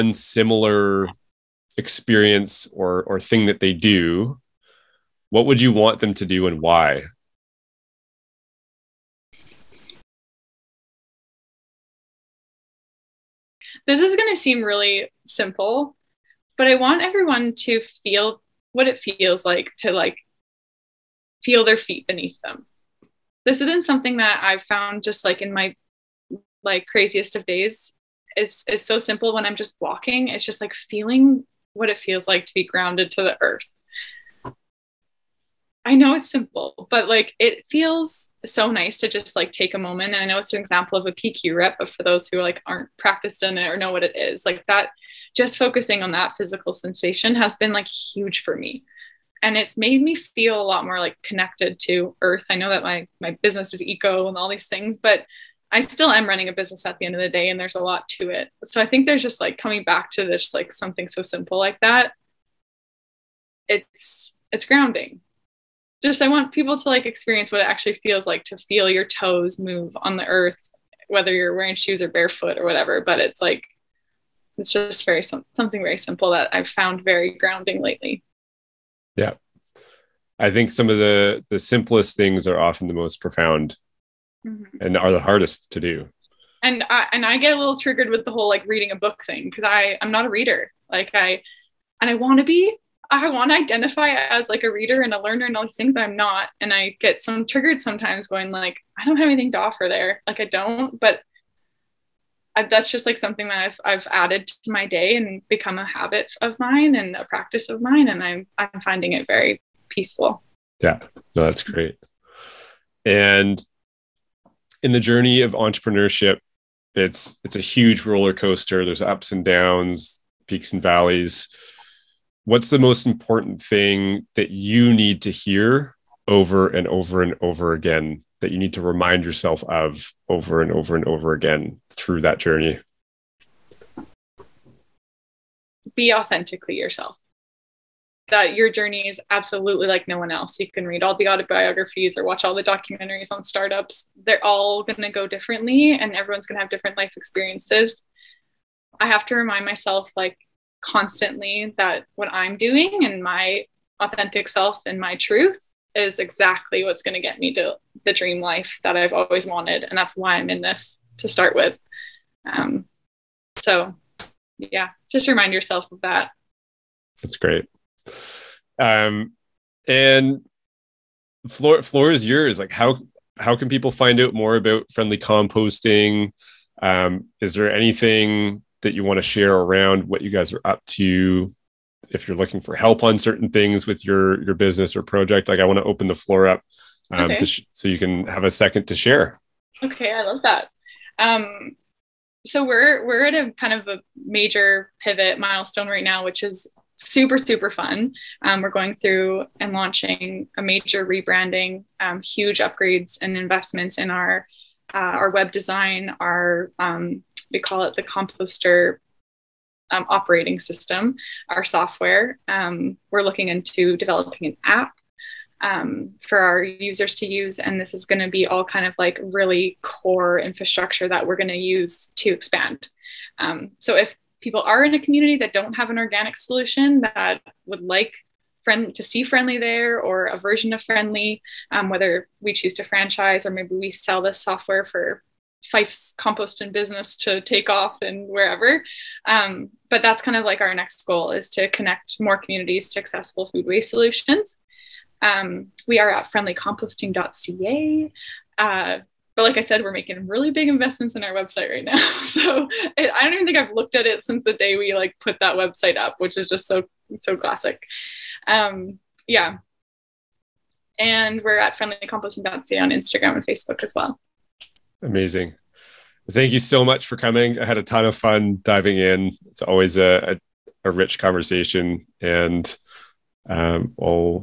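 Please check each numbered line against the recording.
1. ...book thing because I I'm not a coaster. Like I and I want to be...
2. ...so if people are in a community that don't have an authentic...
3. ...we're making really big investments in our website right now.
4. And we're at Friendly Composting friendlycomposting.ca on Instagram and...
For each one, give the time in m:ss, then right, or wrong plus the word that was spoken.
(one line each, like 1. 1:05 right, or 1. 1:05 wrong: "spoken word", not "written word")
1. 1:28 wrong: "reader", not "coaster"
2. 3:43 wrong: "organic", not "authentic"
3. 4:09 right
4. 4:20 right.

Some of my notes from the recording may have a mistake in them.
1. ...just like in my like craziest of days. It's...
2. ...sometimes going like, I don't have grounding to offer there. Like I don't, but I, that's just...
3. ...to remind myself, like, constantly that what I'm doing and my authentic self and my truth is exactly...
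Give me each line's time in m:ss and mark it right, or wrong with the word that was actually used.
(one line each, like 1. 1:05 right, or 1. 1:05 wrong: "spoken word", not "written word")
1. 0:25 right
2. 1:37 wrong: "anything", not "grounding"
3. 2:29 right.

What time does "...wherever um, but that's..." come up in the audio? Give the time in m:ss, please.
3:58.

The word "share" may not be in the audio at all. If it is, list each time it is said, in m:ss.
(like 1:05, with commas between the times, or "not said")
2:59, 3:08.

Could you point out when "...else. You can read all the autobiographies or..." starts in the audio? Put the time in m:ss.
2:20.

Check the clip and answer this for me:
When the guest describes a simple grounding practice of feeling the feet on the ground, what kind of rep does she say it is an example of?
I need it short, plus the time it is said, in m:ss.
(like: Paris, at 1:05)
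PQ rep, at 0:41.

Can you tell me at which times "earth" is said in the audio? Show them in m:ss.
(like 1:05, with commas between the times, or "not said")
0:33, 0:52, 1:10.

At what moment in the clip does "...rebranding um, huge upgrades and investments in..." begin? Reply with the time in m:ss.
3:21.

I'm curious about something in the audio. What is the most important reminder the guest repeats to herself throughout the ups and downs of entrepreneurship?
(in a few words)
Be authentically yourself.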